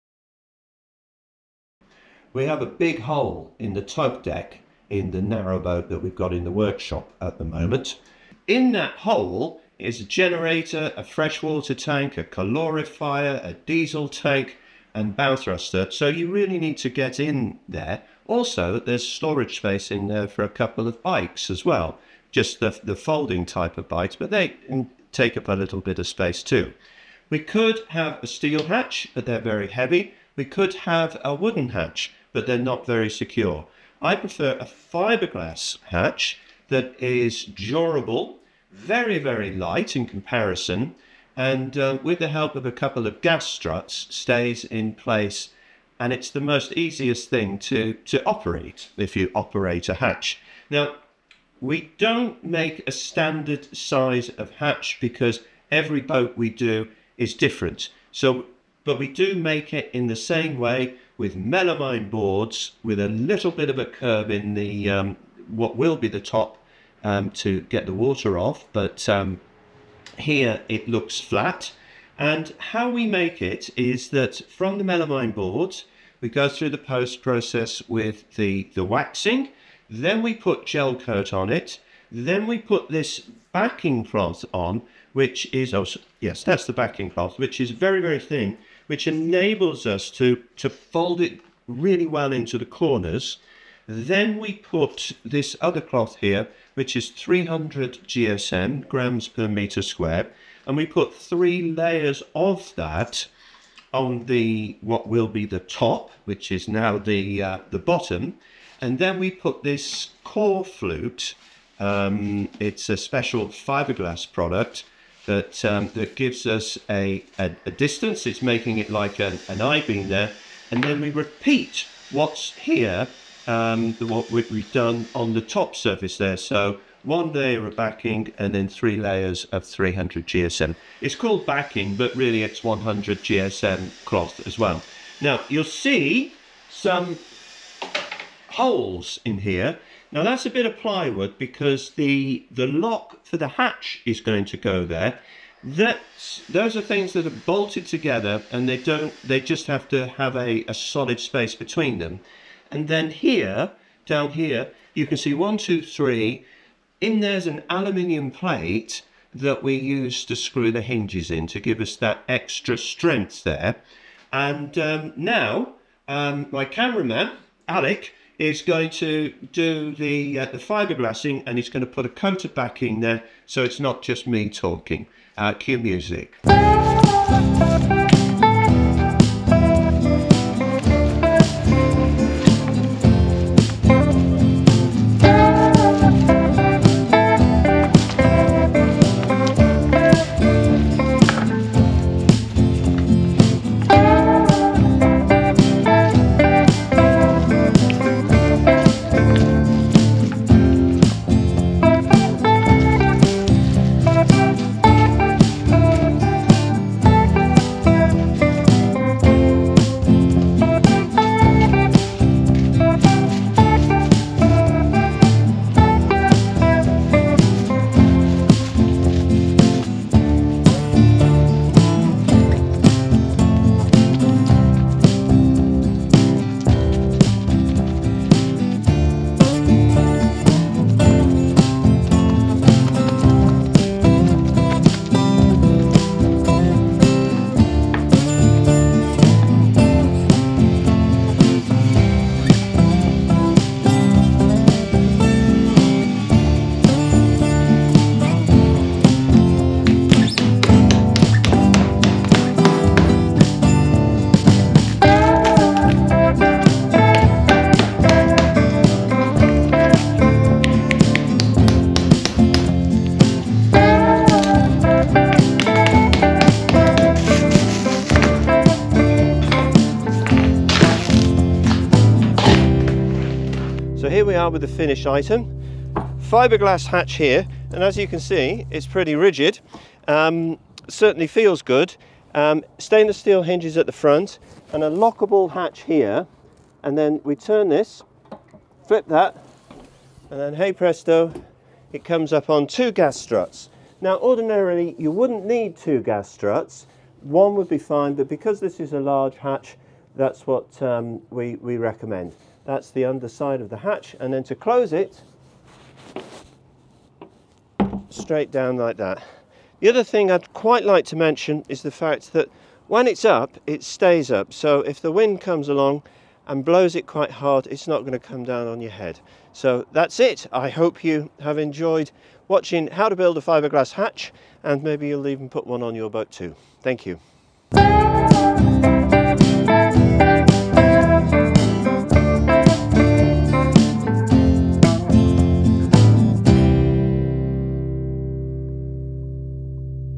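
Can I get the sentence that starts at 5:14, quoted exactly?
So if the wind comes along and blows it quite hard, it's not going to come down on your head.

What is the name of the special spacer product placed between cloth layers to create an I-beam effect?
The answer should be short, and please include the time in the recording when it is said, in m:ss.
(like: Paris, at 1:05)
Core flute, at 1:50.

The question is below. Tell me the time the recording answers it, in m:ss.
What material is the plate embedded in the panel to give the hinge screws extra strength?
2:37.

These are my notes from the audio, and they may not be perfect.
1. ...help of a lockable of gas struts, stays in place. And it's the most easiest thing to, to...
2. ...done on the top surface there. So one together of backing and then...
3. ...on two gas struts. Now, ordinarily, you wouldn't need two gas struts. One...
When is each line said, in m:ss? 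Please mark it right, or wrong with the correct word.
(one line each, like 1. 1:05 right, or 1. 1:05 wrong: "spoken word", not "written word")
1. 0:42 wrong: "couple", not "lockable"
2. 2:04 wrong: "layer", not "together"
3. 4:52 right.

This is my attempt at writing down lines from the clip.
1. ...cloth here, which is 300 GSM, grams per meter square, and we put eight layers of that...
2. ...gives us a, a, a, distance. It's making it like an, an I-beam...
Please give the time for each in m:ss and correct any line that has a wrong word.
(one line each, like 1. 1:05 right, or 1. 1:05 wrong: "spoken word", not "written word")
1. 1:35 wrong: "three", not "eight"
2. 1:56 right.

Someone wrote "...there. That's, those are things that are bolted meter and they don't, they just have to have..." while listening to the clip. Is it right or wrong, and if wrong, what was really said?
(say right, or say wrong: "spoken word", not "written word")
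wrong: "together", not "meter".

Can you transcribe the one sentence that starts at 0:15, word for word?
So you really need to get in there.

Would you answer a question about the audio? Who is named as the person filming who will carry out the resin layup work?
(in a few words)
Alec.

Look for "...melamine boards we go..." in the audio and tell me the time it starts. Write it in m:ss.
1:14.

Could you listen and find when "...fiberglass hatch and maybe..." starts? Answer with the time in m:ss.
5:23.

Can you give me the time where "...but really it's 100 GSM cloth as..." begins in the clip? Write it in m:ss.
2:11.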